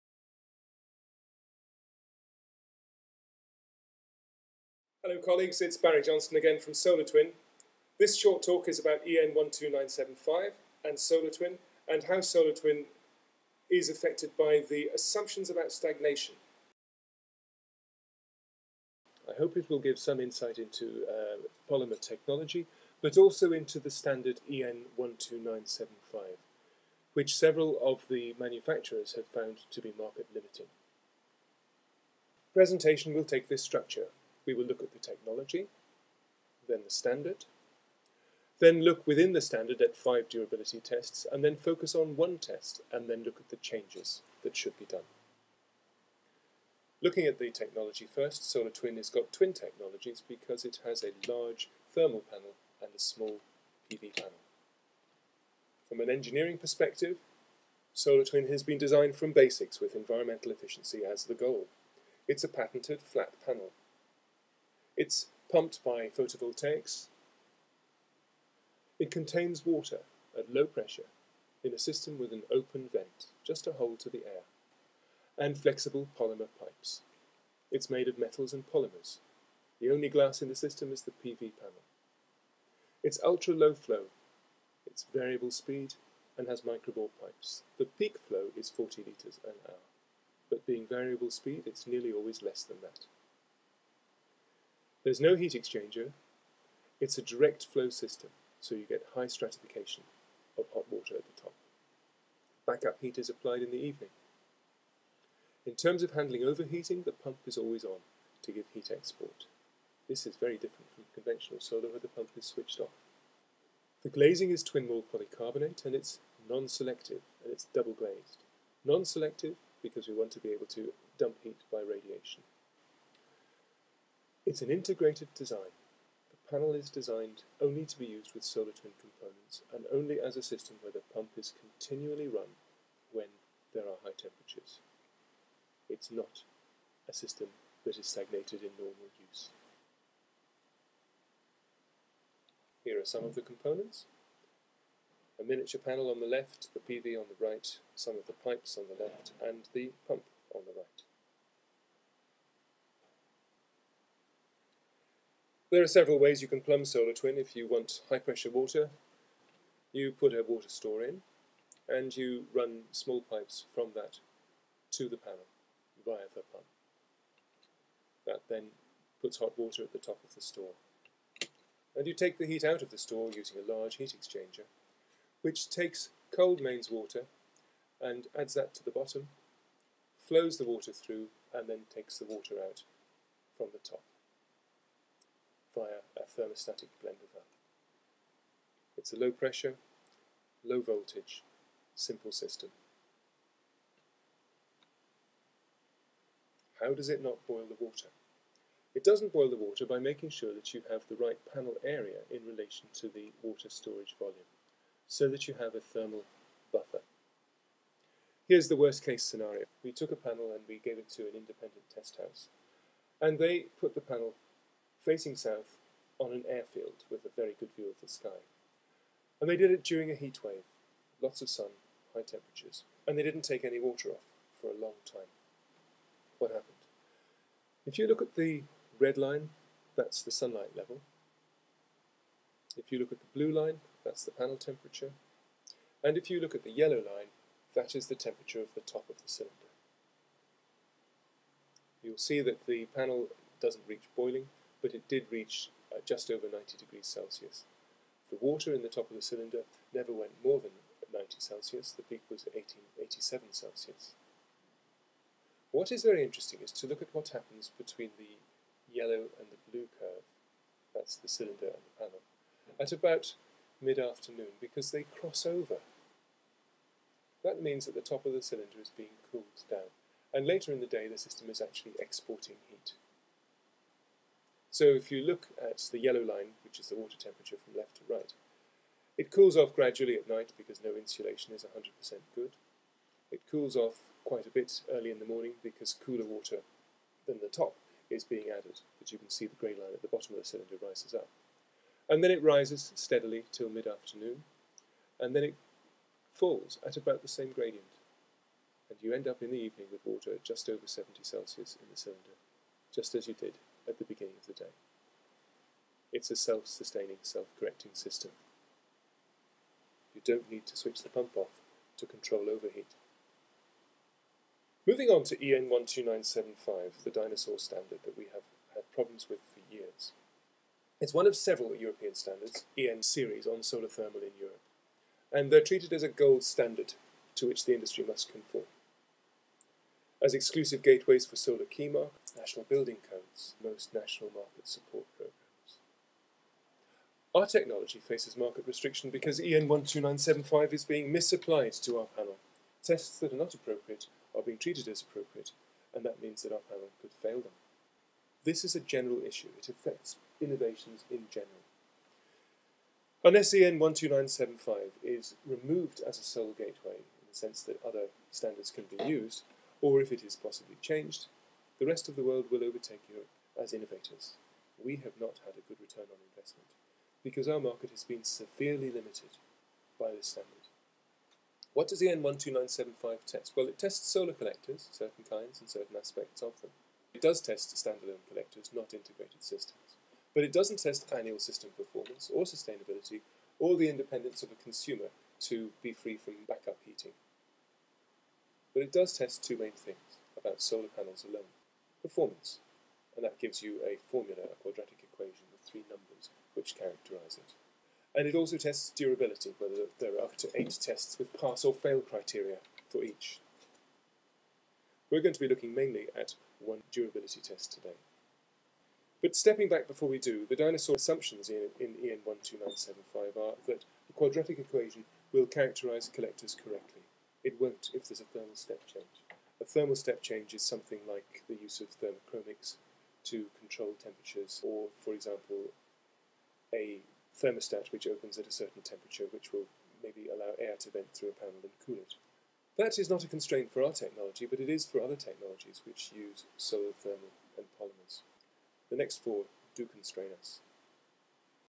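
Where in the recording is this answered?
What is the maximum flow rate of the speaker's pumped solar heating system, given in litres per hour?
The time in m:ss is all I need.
1:28.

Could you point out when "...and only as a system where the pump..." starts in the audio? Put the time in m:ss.
2:09.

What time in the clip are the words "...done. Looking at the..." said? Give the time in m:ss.
0:44.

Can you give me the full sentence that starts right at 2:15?
It's not a system that is stagnated in normal use.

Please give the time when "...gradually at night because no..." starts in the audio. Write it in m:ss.
4:39.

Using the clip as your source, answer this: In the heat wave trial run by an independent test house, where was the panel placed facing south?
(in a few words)
On an airfield.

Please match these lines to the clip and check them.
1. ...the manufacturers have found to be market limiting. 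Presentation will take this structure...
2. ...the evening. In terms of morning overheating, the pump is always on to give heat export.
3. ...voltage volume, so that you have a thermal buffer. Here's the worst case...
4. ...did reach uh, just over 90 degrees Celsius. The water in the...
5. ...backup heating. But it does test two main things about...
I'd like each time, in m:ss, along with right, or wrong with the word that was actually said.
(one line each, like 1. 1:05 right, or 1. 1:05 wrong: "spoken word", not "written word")
1. 0:28 right
2. 1:43 wrong: "handling", not "morning"
3. 3:23 wrong: "storage", not "voltage"
4. 4:05 right
5. 6:26 right.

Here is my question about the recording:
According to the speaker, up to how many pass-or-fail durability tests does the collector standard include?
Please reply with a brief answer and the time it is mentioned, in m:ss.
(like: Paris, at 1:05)
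8, at 6:40.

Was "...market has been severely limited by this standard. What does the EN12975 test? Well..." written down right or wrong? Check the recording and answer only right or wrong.
right.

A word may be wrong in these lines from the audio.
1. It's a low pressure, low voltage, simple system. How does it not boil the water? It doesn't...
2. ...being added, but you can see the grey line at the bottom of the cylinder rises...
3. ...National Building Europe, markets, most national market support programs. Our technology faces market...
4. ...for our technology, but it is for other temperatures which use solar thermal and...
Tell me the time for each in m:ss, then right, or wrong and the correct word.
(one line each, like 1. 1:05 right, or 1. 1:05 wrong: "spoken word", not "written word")
1. 3:08 right
2. 4:48 right
3. 5:32 wrong: "Code", not "Europe"
4. 7:13 wrong: "technologies", not "temperatures".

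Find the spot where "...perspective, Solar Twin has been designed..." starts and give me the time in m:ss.
0:56.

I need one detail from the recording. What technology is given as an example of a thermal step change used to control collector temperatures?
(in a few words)
Thermochromics.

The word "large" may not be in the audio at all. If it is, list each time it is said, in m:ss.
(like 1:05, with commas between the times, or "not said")
0:51, 2:53.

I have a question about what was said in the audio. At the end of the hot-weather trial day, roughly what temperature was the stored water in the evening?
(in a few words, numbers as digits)
Just over 70 Celsius.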